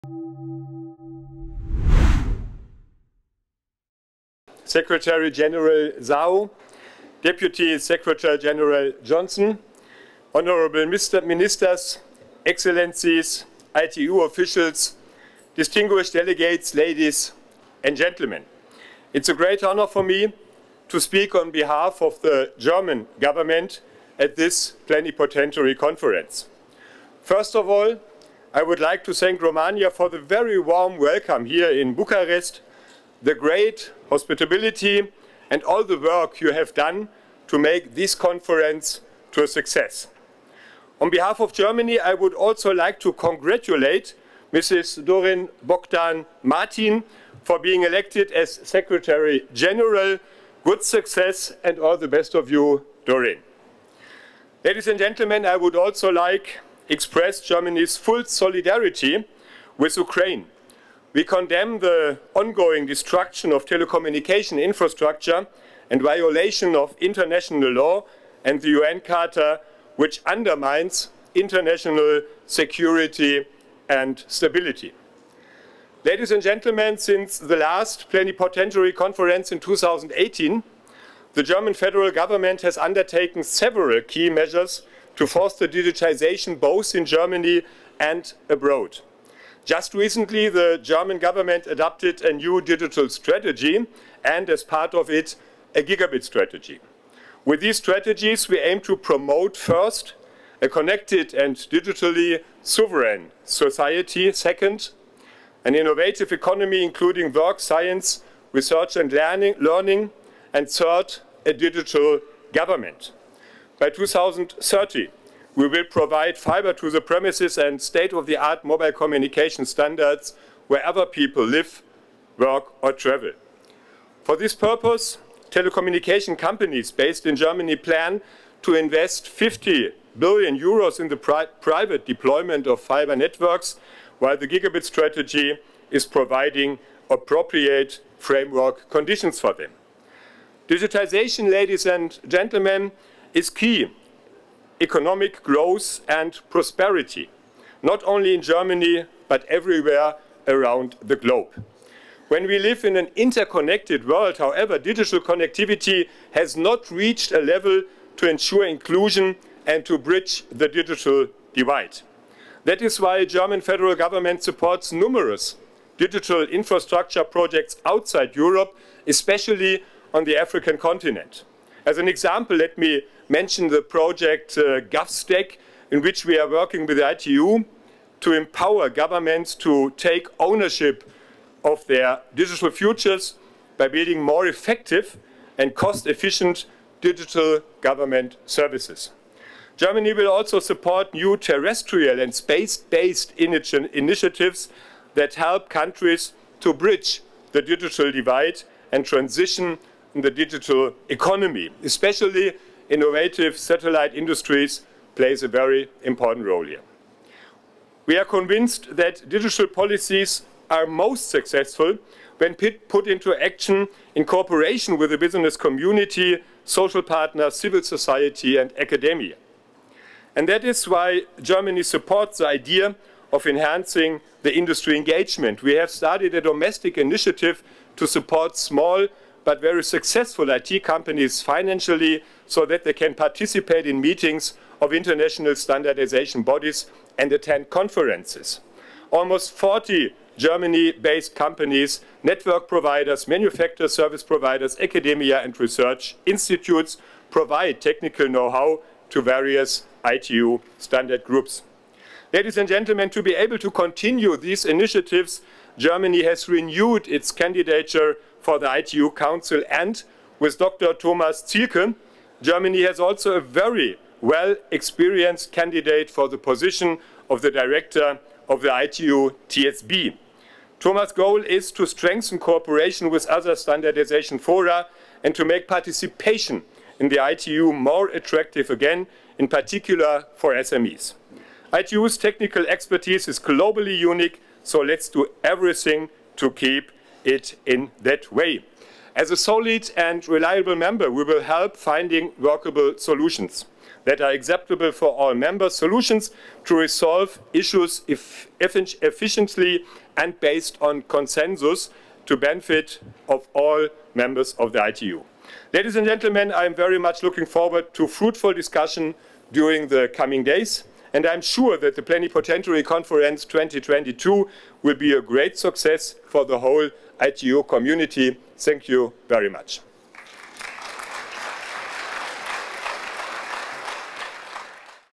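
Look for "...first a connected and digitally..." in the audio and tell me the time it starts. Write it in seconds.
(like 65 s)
99 s.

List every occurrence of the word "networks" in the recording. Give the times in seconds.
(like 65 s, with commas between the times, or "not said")
133 s, 242 s.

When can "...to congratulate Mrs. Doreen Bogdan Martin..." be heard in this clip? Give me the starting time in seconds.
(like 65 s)
42 s.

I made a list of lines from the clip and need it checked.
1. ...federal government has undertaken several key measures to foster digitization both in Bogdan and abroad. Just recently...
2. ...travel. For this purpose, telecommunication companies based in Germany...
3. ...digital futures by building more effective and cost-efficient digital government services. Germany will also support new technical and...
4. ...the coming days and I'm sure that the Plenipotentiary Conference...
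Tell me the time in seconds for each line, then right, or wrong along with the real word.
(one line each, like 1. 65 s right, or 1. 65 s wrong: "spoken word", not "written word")
1. 81 s wrong: "Germany", not "Bogdan"
2. 122 s right
3. 182 s wrong: "terrestrial", not "technical"
4. 309 s right.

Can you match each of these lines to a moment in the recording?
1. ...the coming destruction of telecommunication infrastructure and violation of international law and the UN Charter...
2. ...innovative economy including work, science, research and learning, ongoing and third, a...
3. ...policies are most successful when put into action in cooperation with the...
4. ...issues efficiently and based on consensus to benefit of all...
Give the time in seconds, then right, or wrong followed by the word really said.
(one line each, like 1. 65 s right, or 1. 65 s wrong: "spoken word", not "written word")
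1. 61 s wrong: "ongoing", not "coming"
2. 105 s wrong: "learning", not "ongoing"
3. 209 s right
4. 297 s right.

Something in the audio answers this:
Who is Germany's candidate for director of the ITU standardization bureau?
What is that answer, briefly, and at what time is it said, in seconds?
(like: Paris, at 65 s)
Dr. Thomas Zielke, at 260 s.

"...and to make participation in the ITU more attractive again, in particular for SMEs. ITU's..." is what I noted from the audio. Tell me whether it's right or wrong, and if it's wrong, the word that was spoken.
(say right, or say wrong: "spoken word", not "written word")
right.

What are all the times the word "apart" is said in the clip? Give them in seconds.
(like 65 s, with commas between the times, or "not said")
not said.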